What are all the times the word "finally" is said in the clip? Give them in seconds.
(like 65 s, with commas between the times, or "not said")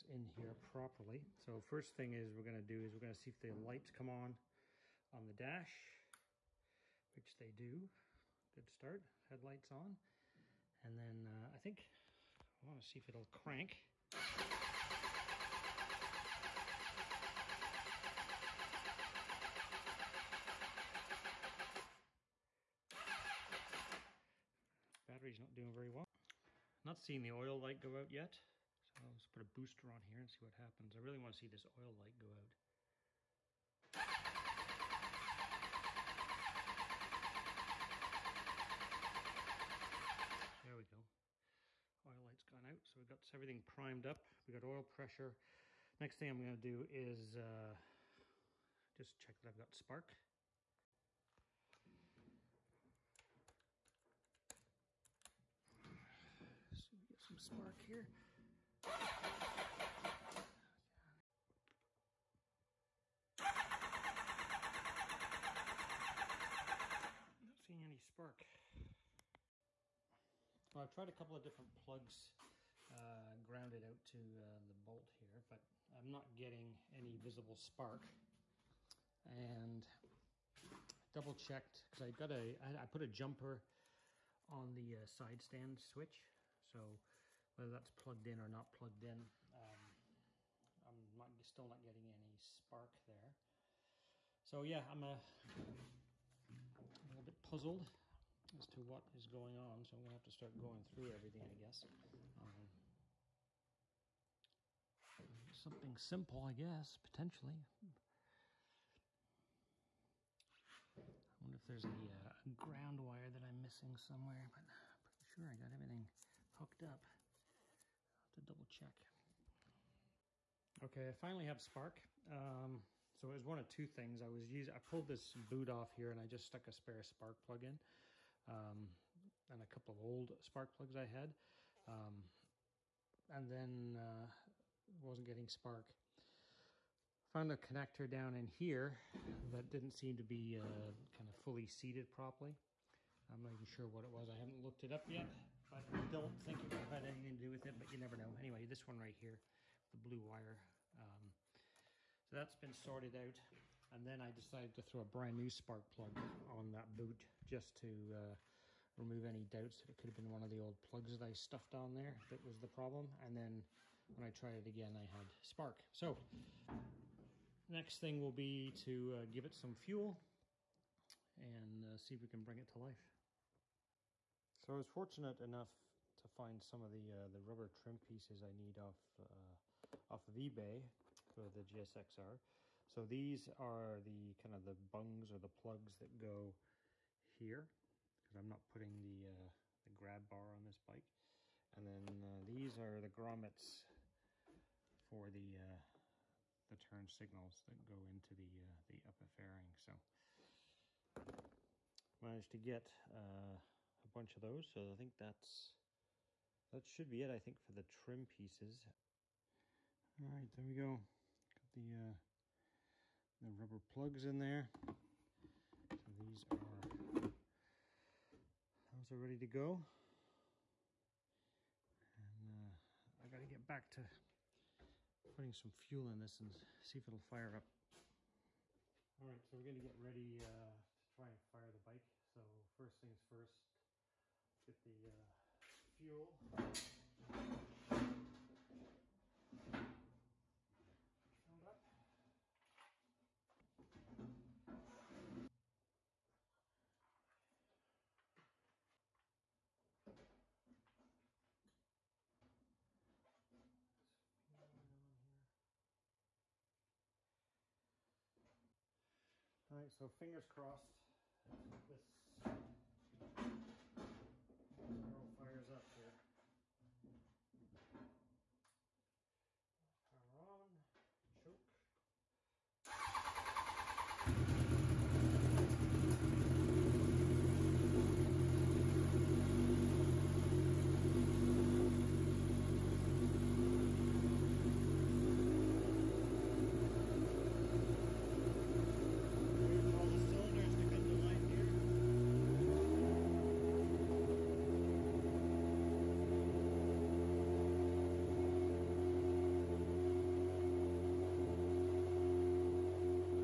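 121 s.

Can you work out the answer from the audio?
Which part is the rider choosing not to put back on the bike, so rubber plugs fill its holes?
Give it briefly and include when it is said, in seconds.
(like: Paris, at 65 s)
Grab bar, at 189 s.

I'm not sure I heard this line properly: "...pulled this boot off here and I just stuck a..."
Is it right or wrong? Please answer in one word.
right.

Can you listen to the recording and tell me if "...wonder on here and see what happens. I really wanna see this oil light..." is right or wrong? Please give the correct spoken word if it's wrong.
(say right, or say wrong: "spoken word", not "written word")
wrong: "booster", not "wonder".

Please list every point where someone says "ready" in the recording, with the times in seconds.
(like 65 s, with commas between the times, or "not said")
219 s, 229 s.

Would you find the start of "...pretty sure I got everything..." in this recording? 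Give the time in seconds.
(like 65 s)
115 s.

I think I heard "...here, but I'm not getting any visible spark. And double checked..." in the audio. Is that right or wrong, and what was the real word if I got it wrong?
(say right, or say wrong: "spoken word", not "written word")
right.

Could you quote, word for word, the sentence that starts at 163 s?
And then when I tried it again, I had spark.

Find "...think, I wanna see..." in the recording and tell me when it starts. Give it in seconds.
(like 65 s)
11 s.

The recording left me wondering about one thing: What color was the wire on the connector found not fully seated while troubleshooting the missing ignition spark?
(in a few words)
Blue.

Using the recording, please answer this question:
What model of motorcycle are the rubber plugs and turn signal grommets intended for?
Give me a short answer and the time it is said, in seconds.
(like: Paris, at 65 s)
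GSXR, at 181 s.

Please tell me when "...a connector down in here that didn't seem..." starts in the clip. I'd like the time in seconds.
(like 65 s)
137 s.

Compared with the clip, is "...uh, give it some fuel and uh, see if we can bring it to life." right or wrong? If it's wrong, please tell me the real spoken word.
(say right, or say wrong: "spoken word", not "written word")
right.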